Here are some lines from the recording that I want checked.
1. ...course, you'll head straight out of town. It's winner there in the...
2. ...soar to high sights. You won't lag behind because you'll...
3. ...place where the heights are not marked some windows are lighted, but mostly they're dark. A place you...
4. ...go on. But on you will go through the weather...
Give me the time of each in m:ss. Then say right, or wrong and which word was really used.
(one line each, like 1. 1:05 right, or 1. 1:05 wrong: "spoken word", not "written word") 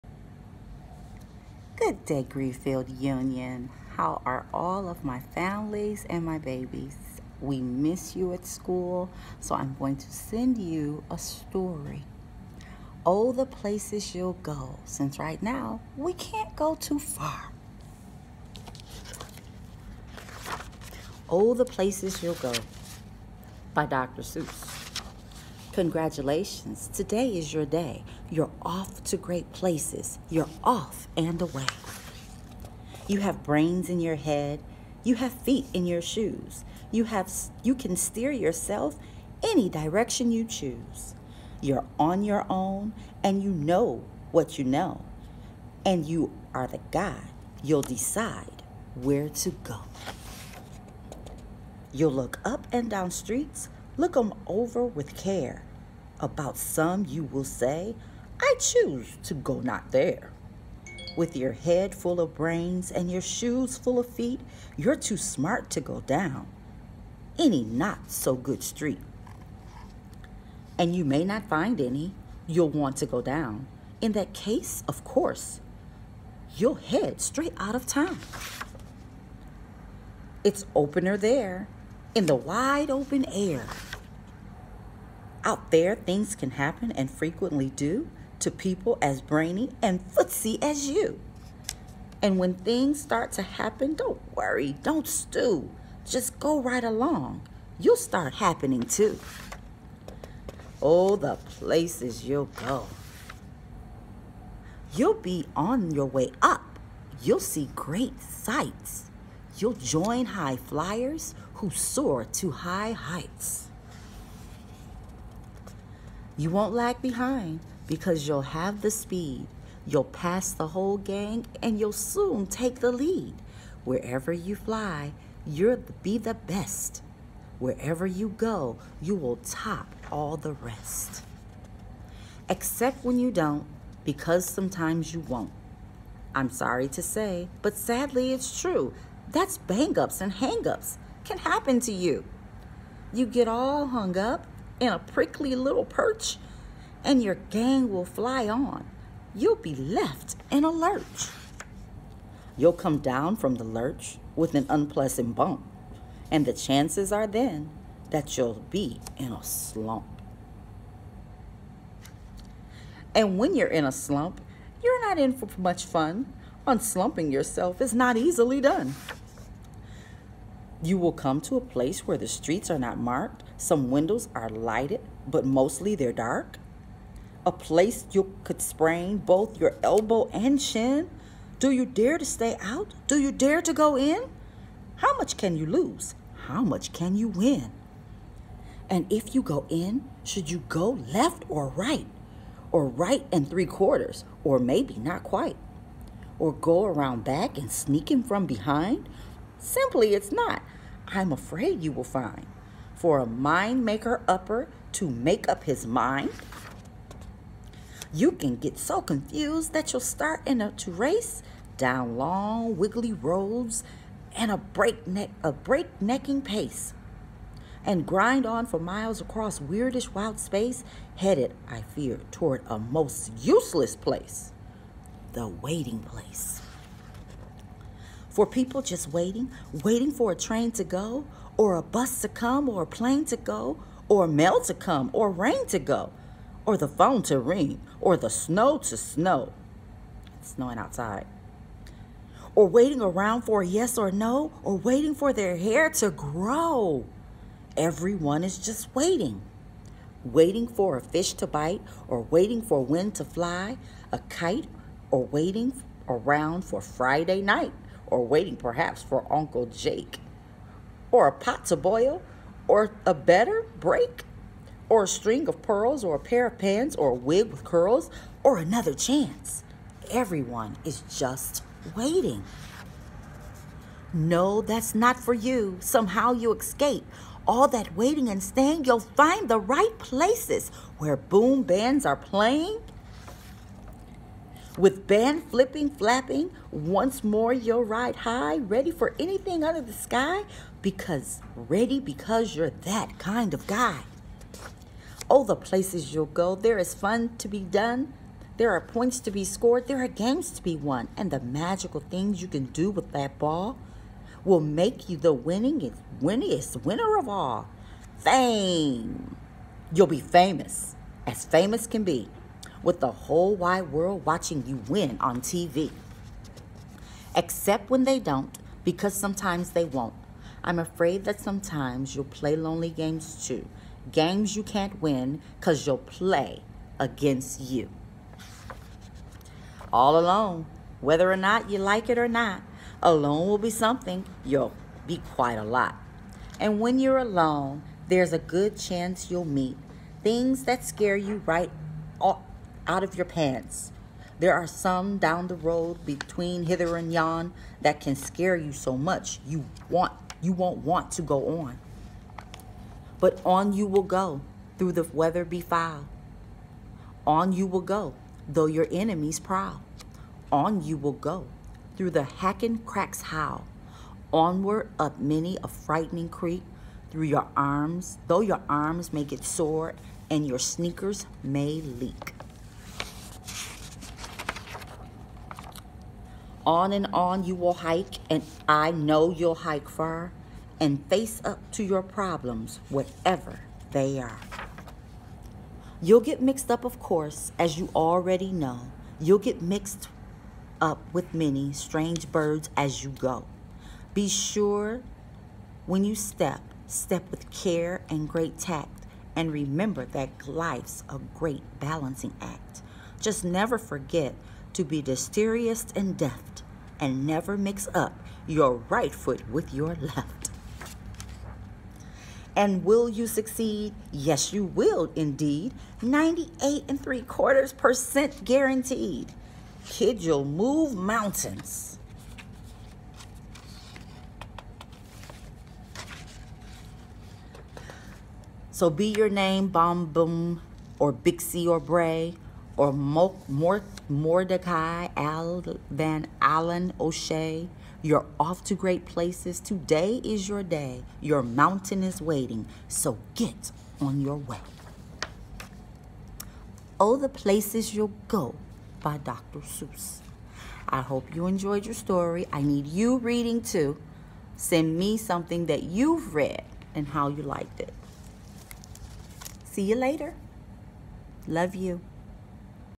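1. 1:15 wrong: "opener", not "winner"
2. 1:51 wrong: "heights", not "sights"
3. 2:51 wrong: "streets", not "heights"
4. 5:51 right.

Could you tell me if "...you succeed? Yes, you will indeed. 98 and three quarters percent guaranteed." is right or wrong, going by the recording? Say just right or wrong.
right.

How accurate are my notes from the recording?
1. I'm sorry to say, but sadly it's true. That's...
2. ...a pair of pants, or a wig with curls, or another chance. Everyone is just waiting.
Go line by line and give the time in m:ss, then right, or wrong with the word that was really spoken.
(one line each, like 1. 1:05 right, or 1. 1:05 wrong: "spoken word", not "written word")
1. 2:16 right
2. 4:26 right.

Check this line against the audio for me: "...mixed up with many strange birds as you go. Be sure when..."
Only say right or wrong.
right.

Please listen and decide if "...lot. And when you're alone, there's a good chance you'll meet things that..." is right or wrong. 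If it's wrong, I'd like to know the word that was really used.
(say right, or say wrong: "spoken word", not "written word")
right.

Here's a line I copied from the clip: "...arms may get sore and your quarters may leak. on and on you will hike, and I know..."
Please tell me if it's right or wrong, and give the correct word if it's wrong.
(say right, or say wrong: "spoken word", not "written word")
wrong: "sneakers", not "quarters".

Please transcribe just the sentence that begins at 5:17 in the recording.
Except when they don't, because sometimes they won't.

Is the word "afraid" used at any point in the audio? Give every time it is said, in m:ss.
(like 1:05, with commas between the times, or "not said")
3:21, 5:20.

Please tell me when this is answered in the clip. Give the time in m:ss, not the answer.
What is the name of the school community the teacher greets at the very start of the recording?
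0:02.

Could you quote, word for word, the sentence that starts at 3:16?
Or go around back and sneak in from behind?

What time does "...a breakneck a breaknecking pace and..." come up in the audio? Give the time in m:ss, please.
3:34.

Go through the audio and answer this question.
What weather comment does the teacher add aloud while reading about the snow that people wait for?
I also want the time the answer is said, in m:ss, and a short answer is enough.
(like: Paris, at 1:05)
It's snowing outside, at 4:00.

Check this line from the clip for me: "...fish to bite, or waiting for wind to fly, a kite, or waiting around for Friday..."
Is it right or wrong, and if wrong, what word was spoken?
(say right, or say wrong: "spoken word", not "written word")
right.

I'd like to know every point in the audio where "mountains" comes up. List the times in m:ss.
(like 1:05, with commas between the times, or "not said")
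7:00, 7:21.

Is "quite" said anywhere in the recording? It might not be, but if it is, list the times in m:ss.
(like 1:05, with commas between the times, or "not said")
3:15, 5:35.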